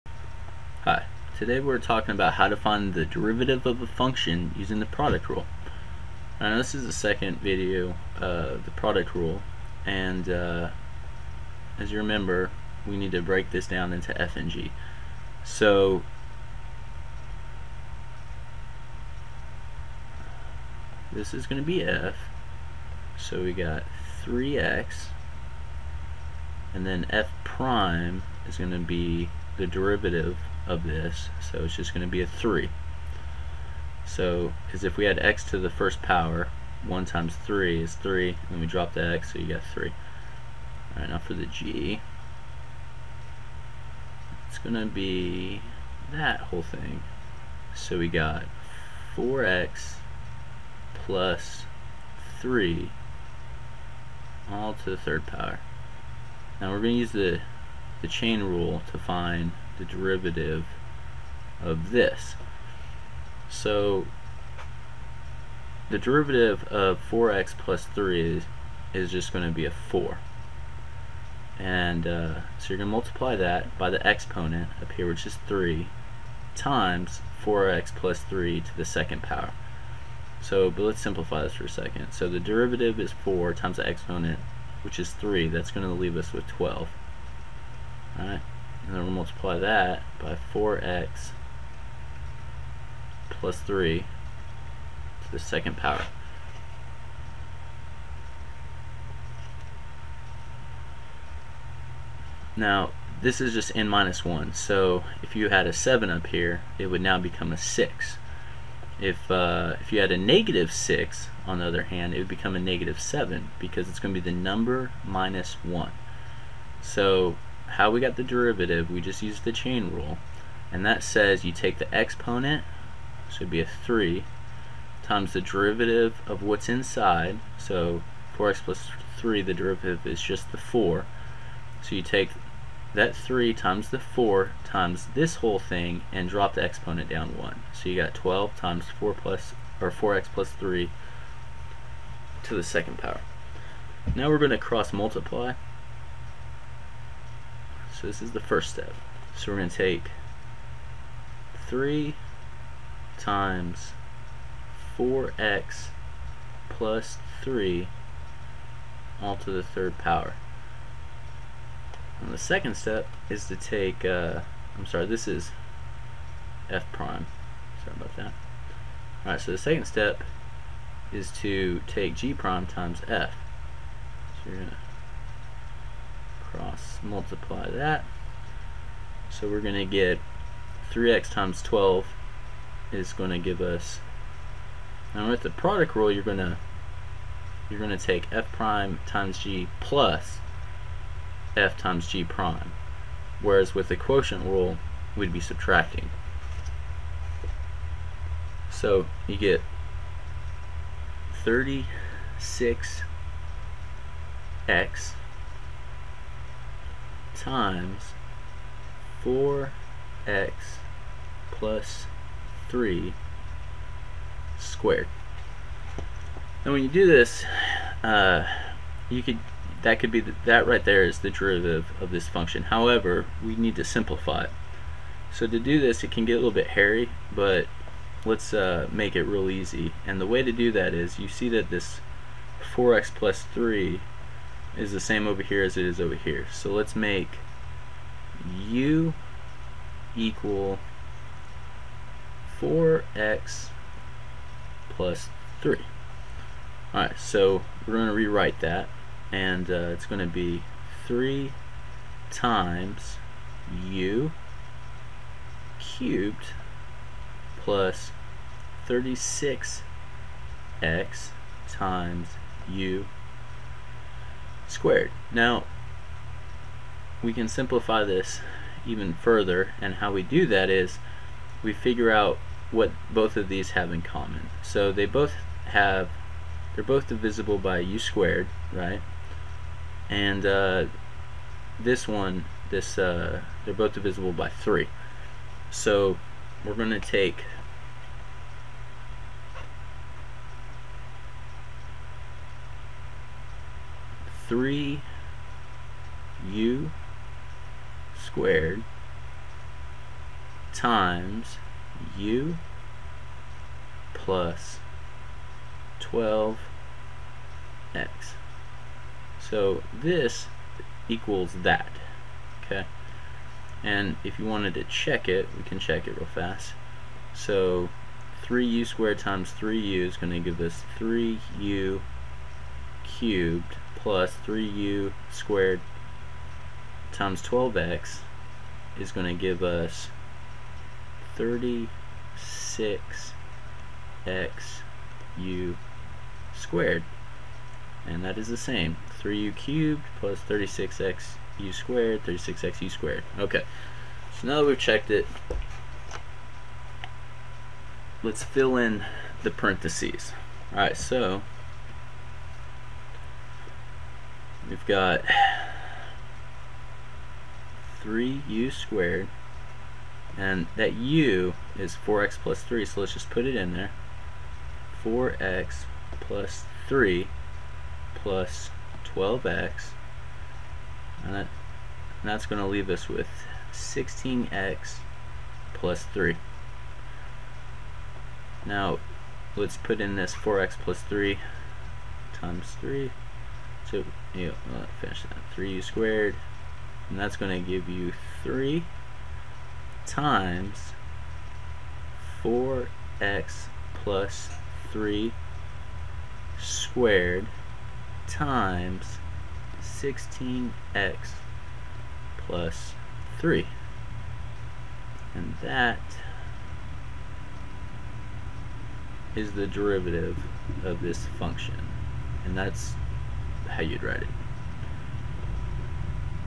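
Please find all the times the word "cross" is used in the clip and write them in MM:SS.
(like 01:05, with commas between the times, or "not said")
02:24, 02:56.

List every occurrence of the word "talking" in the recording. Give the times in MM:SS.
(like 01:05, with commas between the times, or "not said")
00:01.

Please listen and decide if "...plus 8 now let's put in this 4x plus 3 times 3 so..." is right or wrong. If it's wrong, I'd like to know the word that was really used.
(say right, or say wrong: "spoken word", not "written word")
wrong: "3", not "8".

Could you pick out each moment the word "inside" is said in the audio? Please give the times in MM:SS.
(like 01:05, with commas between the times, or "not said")
02:06.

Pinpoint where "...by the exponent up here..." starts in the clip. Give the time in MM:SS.
01:13.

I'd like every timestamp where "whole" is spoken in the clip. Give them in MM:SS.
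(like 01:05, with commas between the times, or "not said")
00:46, 02:15.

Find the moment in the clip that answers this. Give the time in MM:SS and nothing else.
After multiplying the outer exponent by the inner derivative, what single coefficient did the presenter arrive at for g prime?
01:25.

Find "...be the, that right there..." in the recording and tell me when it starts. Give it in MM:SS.
03:40.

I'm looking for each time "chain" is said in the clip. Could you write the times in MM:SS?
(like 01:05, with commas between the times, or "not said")
00:58, 01:59.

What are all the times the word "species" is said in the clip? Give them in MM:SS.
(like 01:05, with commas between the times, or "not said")
not said.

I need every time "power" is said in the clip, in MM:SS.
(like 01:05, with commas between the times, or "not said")
00:36, 00:55, 01:19, 01:35, 02:22, 02:39.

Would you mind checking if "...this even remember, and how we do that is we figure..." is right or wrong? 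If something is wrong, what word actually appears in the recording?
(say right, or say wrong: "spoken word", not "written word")
wrong: "further", not "remember".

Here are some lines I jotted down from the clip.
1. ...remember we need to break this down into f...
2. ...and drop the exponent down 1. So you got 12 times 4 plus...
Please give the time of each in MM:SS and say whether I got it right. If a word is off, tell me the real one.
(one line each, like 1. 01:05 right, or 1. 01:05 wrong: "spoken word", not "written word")
1. 00:11 right
2. 02:16 right.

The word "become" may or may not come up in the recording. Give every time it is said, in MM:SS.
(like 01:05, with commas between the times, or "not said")
01:47, 01:52.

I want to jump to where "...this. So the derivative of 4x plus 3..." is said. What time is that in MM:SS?
01:01.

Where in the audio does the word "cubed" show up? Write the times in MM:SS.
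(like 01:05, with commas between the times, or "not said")
04:15, 05:23, 05:39.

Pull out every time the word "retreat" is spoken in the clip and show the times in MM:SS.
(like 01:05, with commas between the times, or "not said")
not said.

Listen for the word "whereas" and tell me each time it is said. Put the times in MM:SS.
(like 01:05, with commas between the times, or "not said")
03:13.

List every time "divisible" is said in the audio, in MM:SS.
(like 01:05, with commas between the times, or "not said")
04:37, 04:43.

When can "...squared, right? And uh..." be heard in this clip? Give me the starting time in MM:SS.
04:37.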